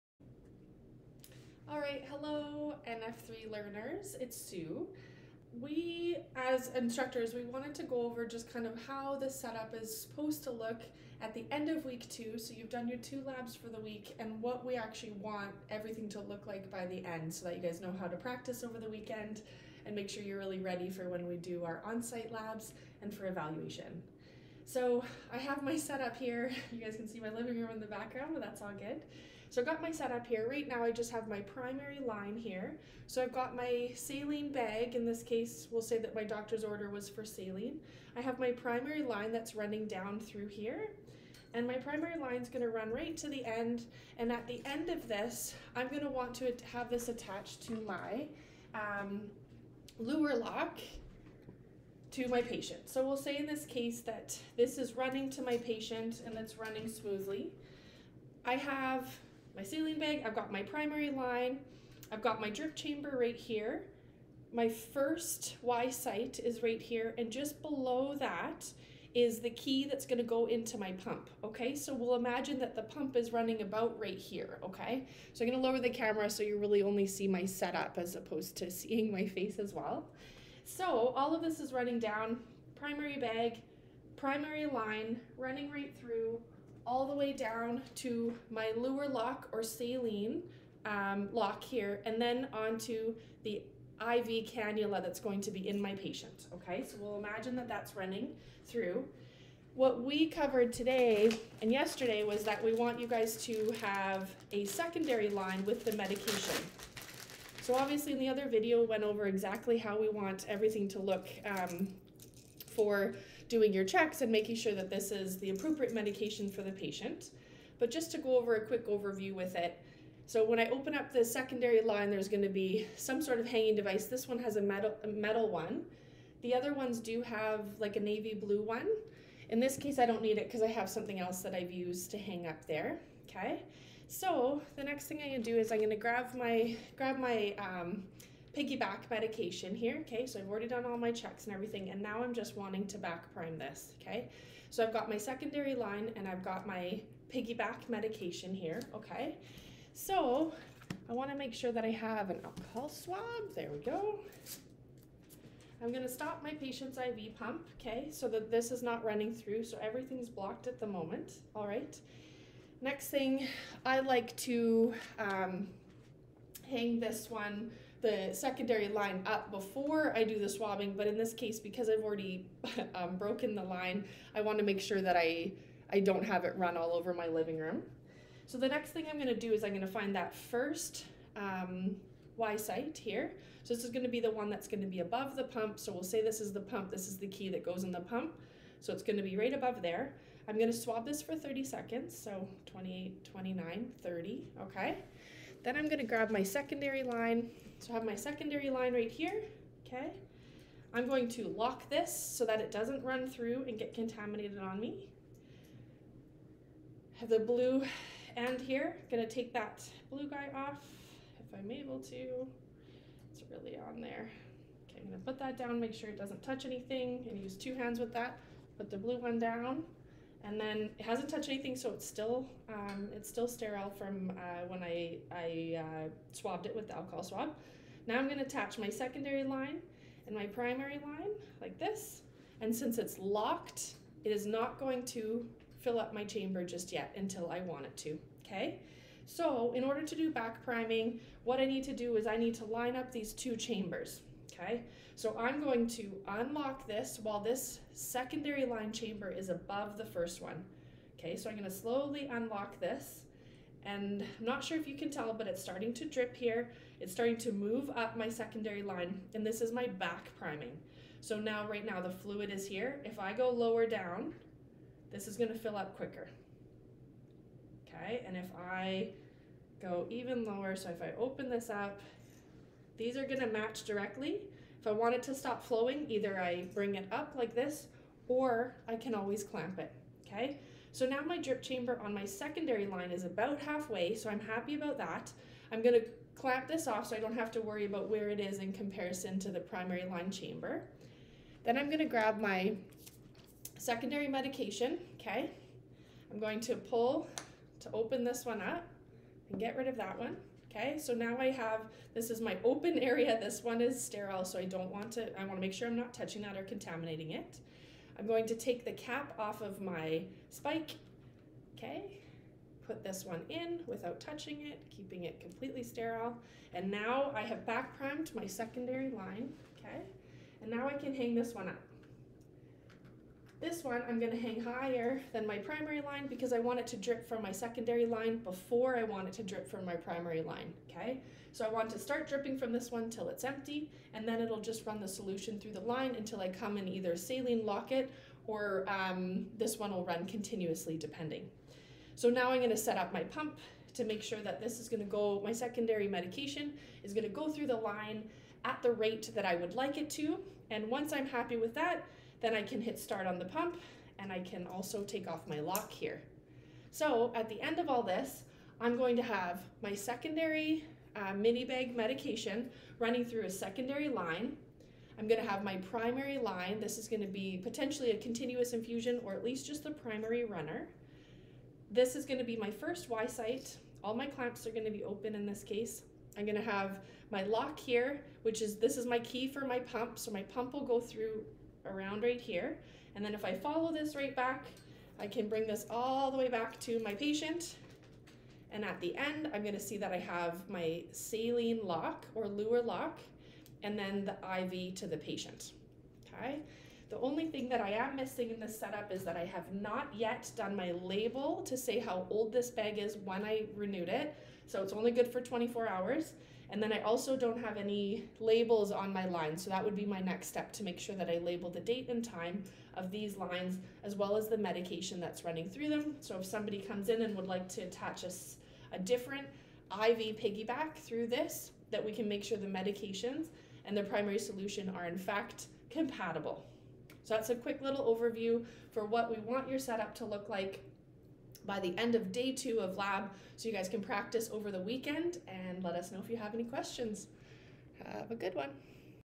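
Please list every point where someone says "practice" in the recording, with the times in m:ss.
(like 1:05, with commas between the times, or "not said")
0:18, 7:14.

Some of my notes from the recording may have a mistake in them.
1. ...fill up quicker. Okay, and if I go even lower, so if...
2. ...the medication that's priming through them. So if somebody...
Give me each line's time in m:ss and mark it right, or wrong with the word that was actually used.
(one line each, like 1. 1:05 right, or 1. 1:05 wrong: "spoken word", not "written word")
1. 4:25 right
2. 6:54 wrong: "running", not "priming".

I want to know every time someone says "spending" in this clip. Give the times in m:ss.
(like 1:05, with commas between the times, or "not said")
not said.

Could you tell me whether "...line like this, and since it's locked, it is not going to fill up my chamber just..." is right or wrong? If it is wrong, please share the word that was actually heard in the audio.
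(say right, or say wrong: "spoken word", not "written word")
right.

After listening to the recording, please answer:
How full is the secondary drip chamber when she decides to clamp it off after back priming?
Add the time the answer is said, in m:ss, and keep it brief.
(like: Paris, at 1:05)
About halfway, at 4:43.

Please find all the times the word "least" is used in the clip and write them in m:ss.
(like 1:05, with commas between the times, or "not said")
6:09.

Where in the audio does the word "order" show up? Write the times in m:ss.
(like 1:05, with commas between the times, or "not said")
0:36, 3:59.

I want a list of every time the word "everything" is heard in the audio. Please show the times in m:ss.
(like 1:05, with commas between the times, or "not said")
0:15, 1:50, 2:21, 2:39.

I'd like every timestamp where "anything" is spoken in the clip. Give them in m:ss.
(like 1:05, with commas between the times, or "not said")
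3:36, 3:41.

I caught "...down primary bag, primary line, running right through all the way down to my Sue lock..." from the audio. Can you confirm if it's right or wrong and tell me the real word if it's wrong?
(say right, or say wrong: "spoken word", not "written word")
wrong: "Luer", not "Sue".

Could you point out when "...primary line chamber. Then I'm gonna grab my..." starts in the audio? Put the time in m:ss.
4:49.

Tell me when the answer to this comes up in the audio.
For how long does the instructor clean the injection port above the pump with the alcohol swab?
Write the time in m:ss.
3:11.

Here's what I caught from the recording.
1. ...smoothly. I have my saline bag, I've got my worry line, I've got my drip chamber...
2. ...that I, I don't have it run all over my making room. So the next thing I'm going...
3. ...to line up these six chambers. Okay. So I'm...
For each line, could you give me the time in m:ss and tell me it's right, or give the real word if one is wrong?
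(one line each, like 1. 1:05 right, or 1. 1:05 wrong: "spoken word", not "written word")
1. 0:56 wrong: "primary", not "worry"
2. 2:54 wrong: "living", not "making"
3. 4:02 wrong: "two", not "six".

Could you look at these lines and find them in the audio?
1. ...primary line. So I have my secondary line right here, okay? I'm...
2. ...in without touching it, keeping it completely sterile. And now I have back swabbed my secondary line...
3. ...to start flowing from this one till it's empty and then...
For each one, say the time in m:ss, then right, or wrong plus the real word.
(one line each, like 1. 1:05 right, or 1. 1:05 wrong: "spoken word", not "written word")
1. 3:16 wrong: "secondary", not "primary"
2. 5:13 wrong: "primed", not "swabbed"
3. 5:31 wrong: "dripping", not "flowing".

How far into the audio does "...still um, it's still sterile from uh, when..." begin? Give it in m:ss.
3:42.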